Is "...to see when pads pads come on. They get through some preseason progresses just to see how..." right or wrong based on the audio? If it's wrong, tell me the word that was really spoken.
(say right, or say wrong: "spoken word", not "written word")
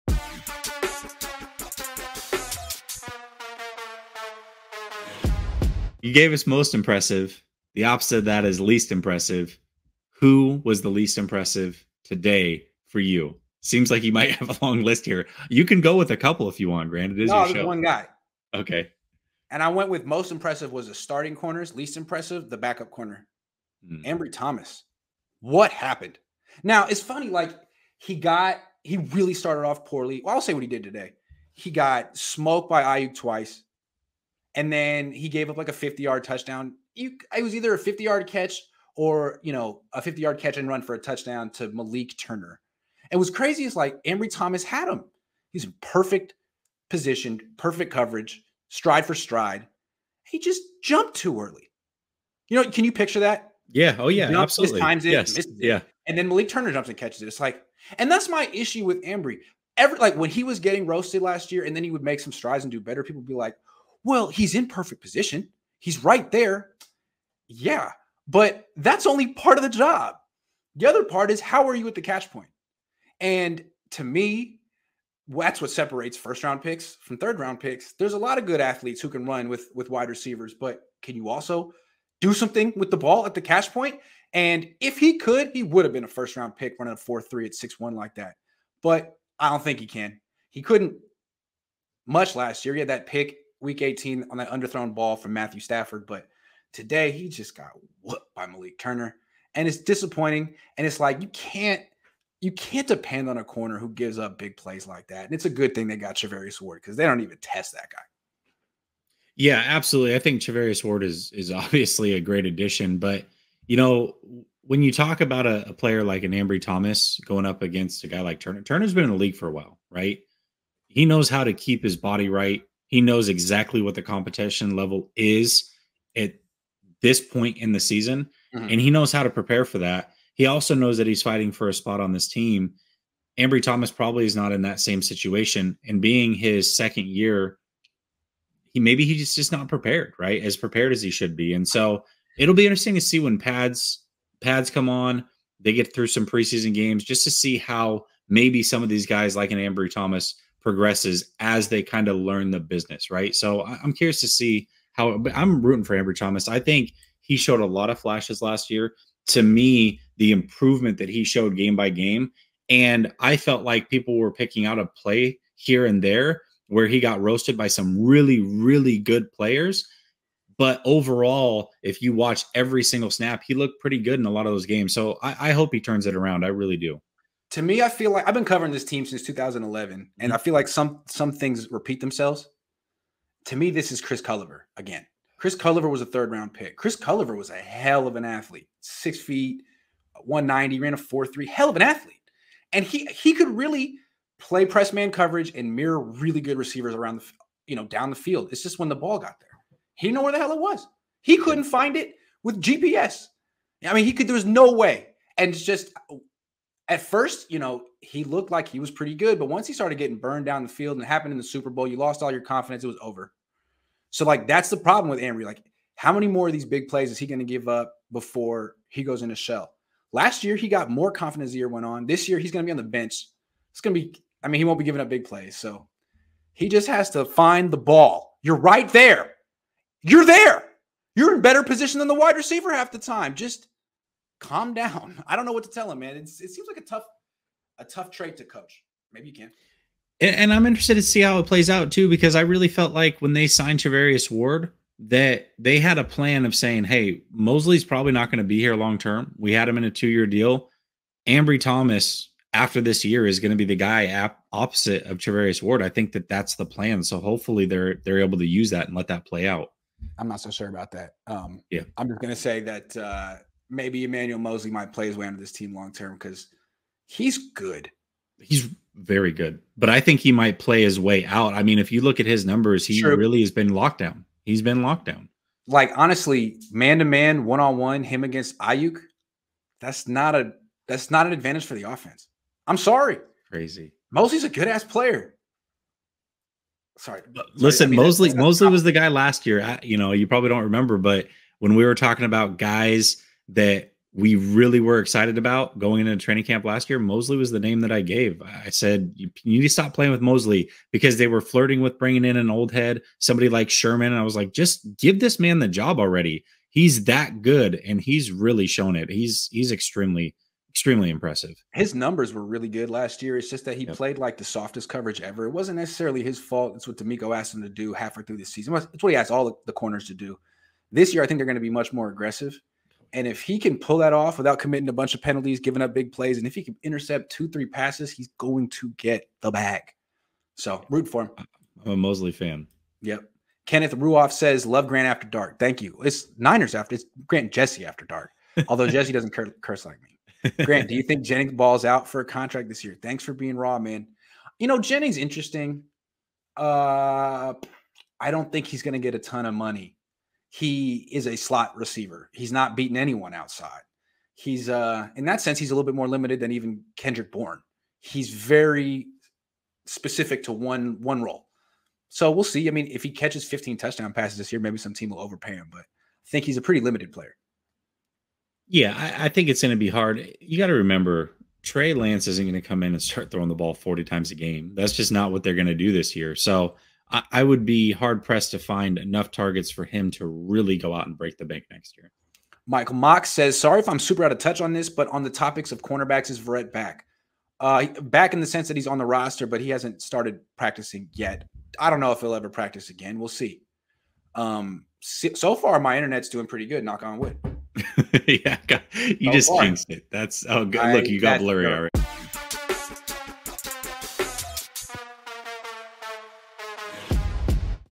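wrong: "games", not "progresses".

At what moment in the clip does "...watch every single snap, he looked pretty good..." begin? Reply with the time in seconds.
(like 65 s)
172 s.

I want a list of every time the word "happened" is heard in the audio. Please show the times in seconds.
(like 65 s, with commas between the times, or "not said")
25 s, 211 s.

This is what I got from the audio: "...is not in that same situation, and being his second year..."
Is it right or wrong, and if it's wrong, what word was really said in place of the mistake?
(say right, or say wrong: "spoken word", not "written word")
right.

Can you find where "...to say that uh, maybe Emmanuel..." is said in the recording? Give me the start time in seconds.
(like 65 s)
262 s.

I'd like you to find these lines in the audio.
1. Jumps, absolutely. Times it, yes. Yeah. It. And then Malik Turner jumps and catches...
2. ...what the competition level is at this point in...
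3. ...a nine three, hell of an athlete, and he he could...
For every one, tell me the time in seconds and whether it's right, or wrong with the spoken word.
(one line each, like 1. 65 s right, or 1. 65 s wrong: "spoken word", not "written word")
1. 54 s right
2. 123 s right
3. 190 s wrong: "four", not "nine".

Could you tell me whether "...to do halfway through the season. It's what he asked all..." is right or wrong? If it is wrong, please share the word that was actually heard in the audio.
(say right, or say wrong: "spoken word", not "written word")
right.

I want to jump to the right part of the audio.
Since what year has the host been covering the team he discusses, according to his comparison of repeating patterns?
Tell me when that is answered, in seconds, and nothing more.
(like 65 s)
179 s.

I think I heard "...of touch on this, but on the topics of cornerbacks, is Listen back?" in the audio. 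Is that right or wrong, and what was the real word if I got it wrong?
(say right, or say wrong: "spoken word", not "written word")
wrong: "Verrett", not "Listen".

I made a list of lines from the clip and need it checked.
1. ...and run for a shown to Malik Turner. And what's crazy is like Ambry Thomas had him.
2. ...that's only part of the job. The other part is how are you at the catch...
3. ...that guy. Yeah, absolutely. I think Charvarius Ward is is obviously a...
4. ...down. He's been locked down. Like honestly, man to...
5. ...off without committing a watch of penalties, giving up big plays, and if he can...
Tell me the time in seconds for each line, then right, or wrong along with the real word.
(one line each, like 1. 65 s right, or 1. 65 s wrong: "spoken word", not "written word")
1. 40 s wrong: "touchdown", not "shown"
2. 68 s right
3. 107 s right
4. 273 s right
5. 324 s wrong: "bunch", not "watch".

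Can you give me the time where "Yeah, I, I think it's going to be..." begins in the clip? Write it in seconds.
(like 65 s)
368 s.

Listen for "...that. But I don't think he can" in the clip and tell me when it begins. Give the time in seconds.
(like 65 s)
88 s.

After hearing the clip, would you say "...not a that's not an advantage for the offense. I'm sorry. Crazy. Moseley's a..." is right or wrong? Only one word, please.
right.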